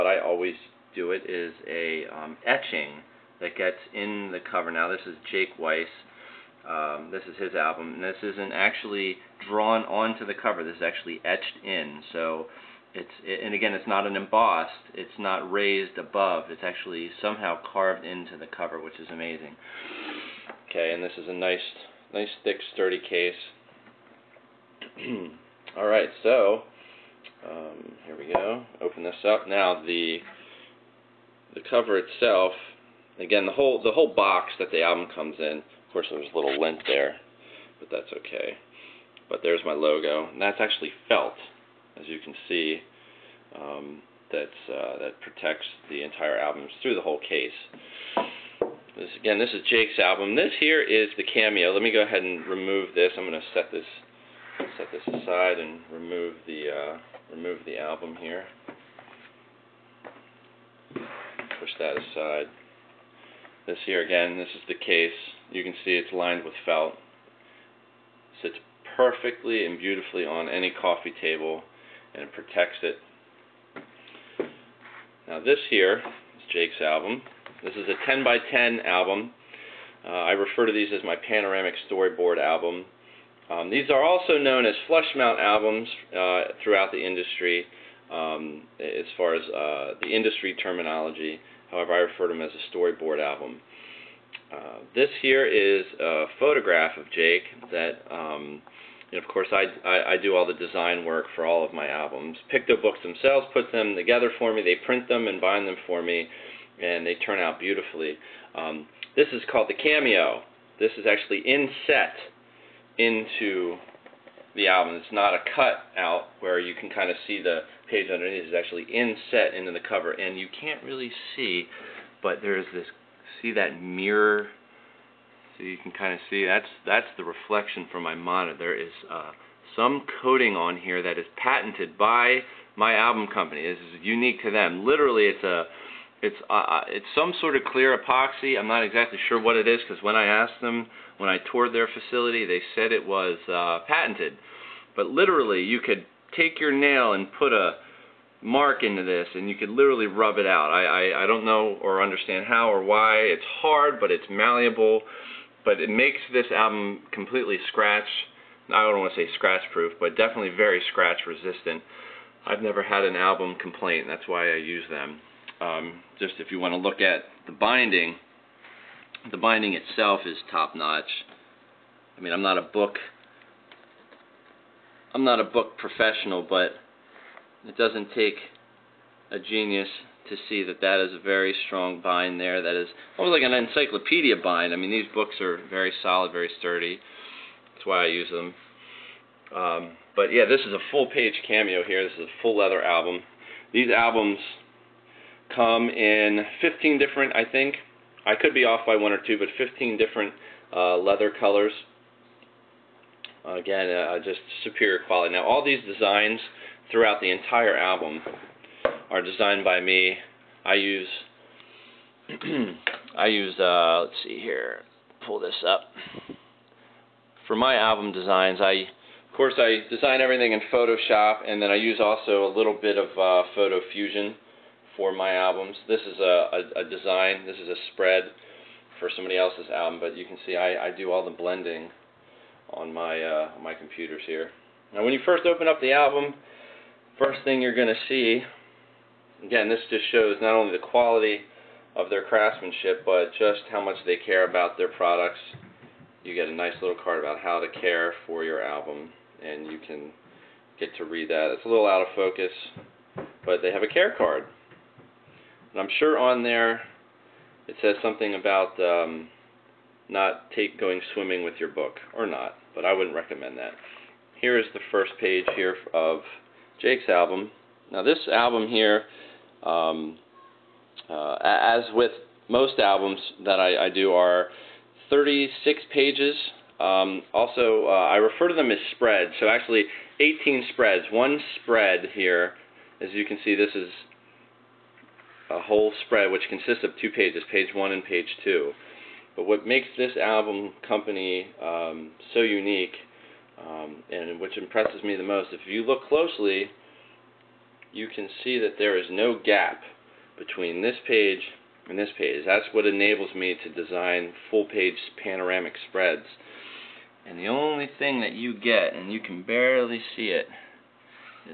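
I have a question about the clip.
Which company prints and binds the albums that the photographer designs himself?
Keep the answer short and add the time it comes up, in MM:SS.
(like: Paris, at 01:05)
PictoBooks, at 01:42.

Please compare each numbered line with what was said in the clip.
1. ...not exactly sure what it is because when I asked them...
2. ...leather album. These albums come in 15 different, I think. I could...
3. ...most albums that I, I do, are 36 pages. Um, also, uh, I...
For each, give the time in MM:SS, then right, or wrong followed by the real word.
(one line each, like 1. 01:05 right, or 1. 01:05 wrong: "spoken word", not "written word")
1. 02:18 right
2. 03:12 right
3. 04:32 right.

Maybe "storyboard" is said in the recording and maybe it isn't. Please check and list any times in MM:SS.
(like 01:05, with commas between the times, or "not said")
01:21, 01:32.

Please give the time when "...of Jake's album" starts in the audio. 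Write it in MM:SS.
04:25.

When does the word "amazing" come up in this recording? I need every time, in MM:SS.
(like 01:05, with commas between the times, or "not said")
00:19.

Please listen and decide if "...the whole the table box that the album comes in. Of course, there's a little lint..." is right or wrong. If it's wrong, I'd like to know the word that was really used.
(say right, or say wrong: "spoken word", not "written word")
wrong: "whole", not "table".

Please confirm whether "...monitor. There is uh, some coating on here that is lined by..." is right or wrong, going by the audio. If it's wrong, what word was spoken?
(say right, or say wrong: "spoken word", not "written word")
wrong: "patented", not "lined".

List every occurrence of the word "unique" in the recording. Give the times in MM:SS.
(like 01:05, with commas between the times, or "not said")
02:14, 04:52.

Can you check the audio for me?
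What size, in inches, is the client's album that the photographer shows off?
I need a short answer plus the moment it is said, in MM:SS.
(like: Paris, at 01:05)
10 by 10, at 01:18.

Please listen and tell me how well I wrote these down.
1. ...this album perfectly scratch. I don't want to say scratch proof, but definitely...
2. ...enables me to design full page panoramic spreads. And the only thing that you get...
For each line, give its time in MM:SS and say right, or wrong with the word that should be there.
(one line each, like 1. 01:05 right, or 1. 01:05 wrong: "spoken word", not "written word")
1. 02:36 wrong: "completely", not "perfectly"
2. 05:02 right.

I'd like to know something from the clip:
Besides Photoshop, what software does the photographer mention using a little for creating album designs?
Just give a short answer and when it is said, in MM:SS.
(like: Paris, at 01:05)
Photo Fusion, at 03:43.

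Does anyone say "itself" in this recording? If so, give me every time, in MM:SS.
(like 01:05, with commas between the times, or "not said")
00:31, 02:49.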